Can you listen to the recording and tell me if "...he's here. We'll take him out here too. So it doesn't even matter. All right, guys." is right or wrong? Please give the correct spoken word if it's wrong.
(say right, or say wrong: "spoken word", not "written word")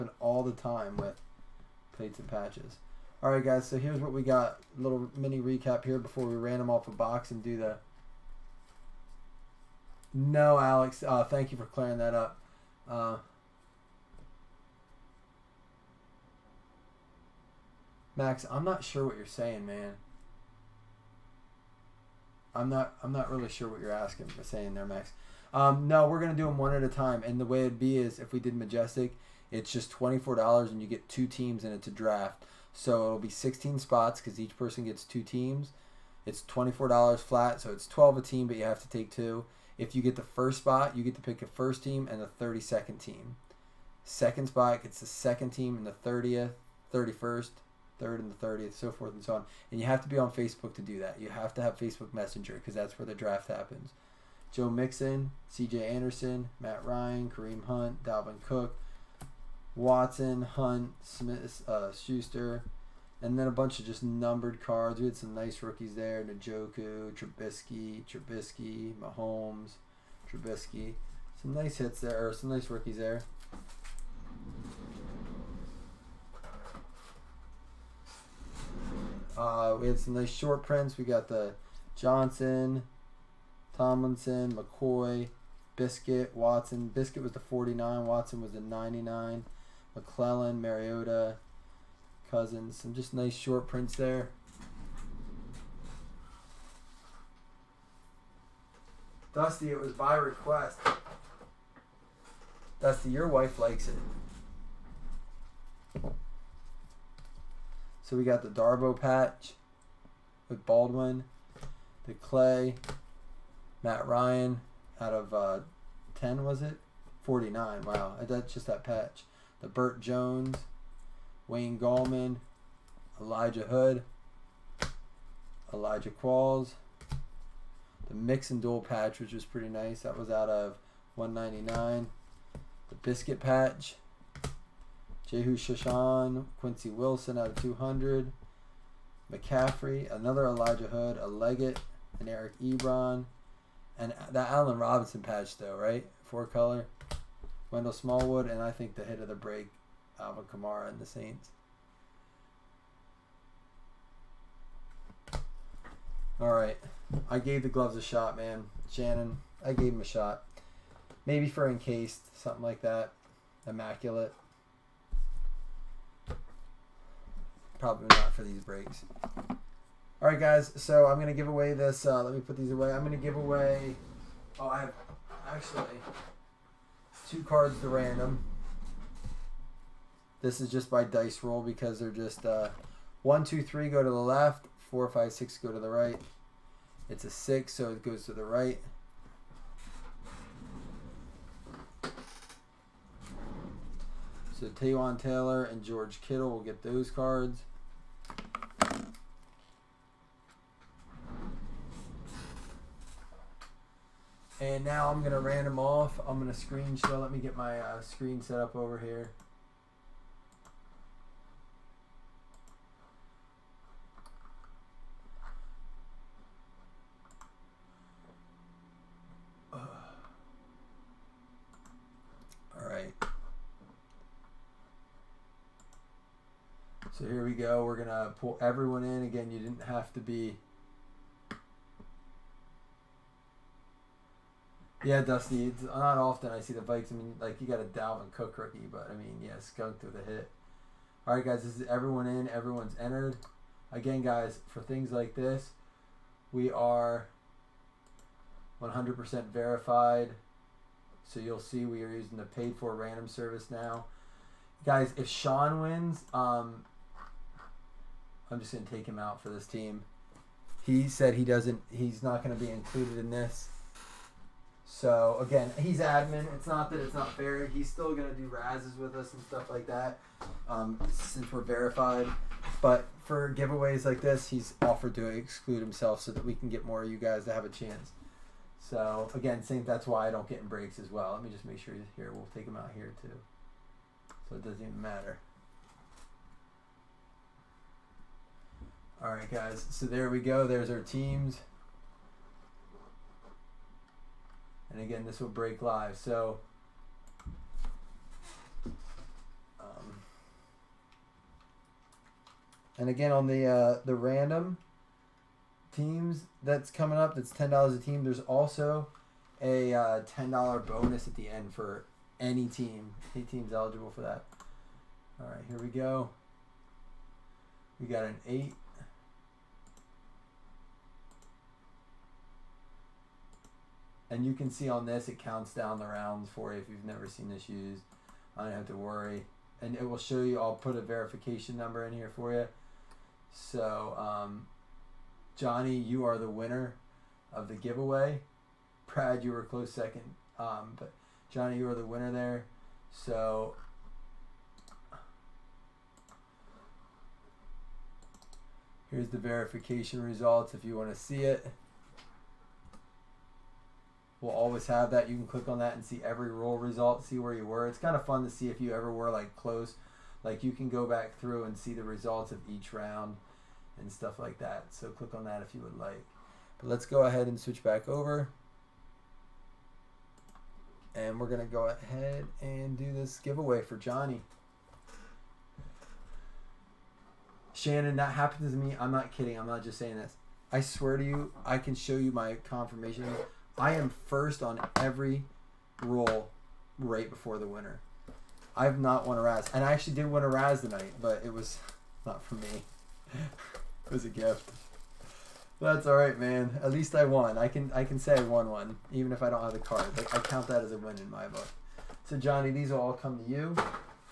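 right.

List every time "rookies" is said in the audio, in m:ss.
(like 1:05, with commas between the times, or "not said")
1:05, 1:12, 3:58.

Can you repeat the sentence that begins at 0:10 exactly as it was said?
No, Alex, uh, thank you for clearing that up.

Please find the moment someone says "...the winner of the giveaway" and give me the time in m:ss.
5:36.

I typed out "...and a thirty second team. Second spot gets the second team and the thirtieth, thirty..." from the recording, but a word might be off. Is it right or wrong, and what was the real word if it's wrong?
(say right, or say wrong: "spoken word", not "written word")
right.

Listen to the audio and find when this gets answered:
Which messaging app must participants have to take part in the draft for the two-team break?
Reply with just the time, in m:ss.
0:51.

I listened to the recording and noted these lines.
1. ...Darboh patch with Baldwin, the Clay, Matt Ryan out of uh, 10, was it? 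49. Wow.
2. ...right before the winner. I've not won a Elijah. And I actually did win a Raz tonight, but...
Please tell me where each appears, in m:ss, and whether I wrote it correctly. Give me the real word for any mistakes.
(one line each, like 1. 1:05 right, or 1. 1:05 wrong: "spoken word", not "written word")
1. 1:48 right
2. 6:26 wrong: "Raz", not "Elijah".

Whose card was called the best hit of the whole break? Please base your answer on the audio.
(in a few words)
Alvin Kamara.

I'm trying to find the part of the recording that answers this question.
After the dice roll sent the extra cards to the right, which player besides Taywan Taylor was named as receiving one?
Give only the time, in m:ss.
3:15.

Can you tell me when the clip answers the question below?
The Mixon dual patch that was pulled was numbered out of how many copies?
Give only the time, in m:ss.
2:11.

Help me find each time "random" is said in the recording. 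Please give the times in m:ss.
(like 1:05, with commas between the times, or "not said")
2:57, 3:25, 4:12, 5:04.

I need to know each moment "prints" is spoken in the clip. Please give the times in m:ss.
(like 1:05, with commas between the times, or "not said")
1:20, 1:33.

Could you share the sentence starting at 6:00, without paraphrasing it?
Like you can go back through and see the results of each round and stuff like that.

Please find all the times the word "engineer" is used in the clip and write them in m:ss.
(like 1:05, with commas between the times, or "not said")
not said.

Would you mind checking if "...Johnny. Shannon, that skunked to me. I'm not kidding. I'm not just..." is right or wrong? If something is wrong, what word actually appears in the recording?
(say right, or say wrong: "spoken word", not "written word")
wrong: "happened", not "skunked".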